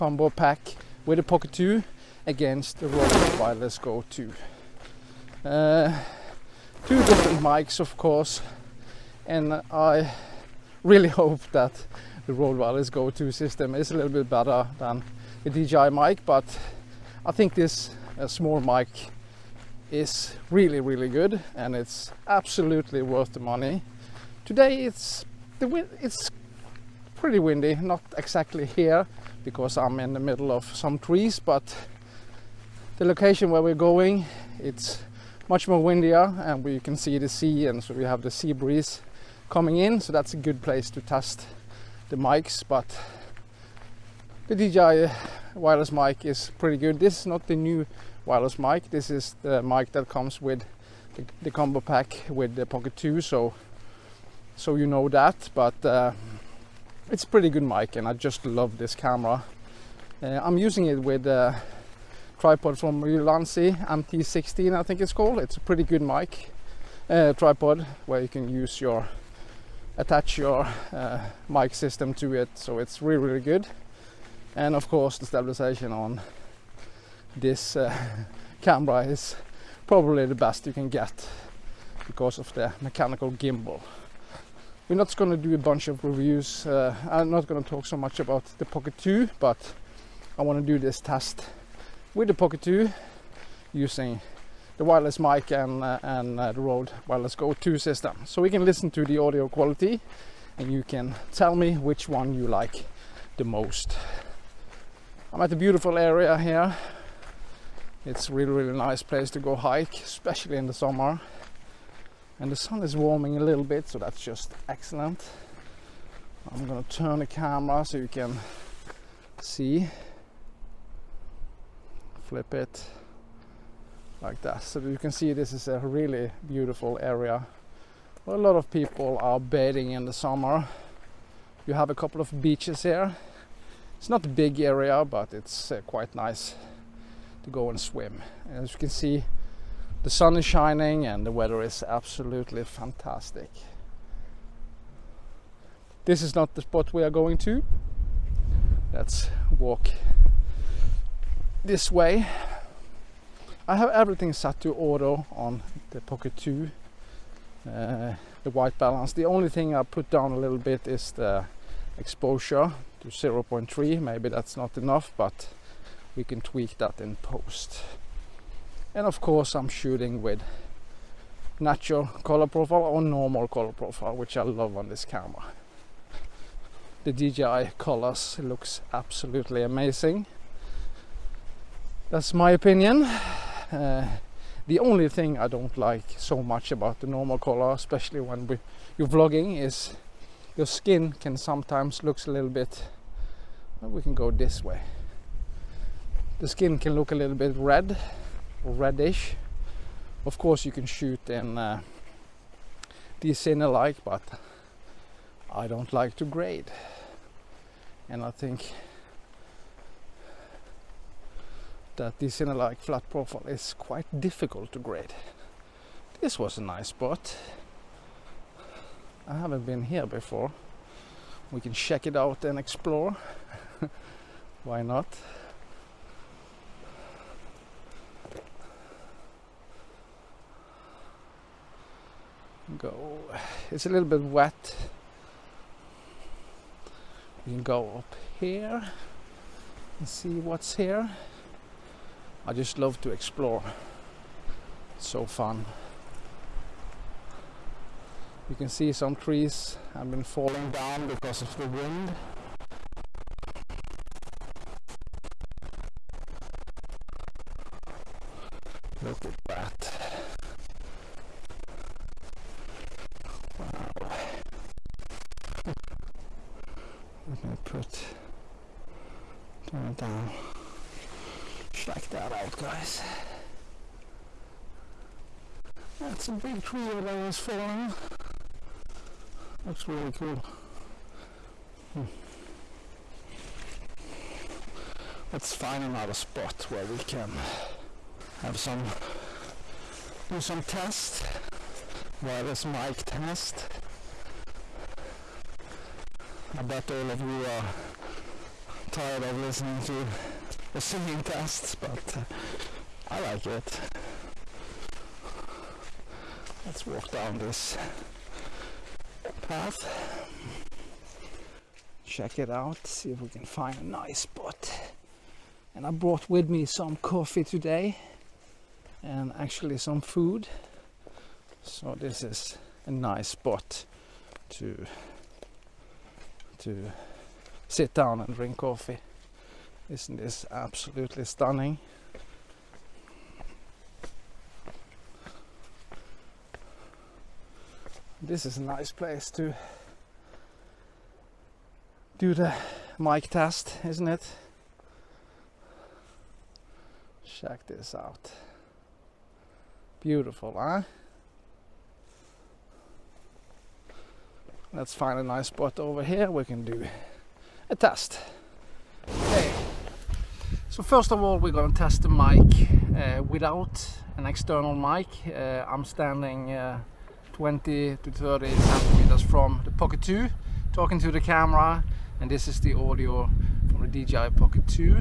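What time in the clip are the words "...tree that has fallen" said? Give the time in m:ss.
4:36.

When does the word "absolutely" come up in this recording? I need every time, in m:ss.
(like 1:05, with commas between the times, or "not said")
0:22, 2:21, 2:58, 5:30.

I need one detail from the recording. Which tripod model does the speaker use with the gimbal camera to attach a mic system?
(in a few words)
Ulanzi MT16.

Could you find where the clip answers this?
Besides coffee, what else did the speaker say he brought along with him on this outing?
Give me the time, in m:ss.
5:19.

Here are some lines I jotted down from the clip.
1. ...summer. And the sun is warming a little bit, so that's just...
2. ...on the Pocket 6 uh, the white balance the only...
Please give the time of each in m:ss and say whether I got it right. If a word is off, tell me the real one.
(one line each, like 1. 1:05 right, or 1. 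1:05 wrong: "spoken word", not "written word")
1. 1:50 right
2. 2:35 wrong: "2", not "6".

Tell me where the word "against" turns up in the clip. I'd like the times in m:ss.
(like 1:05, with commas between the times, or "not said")
0:02.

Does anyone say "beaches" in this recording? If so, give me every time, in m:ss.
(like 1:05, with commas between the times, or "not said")
2:12.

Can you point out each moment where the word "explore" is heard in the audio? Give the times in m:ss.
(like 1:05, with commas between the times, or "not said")
3:42, 4:03.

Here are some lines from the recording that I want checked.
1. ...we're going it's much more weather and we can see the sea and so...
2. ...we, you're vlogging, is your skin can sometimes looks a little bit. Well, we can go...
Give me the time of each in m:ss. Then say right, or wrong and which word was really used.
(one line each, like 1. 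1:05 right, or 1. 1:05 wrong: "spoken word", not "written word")
1. 0:33 wrong: "windier", not "weather"
2. 3:08 right.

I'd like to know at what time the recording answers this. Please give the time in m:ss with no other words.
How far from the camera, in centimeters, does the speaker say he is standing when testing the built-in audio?
6:07.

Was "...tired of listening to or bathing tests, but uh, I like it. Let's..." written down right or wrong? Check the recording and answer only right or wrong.
wrong.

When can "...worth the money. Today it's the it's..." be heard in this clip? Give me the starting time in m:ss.
0:23.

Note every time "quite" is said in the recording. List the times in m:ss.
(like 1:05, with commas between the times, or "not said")
2:15, 3:33.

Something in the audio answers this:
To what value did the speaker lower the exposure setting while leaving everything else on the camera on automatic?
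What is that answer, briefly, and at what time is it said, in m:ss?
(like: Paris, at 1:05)
0.3, at 2:43.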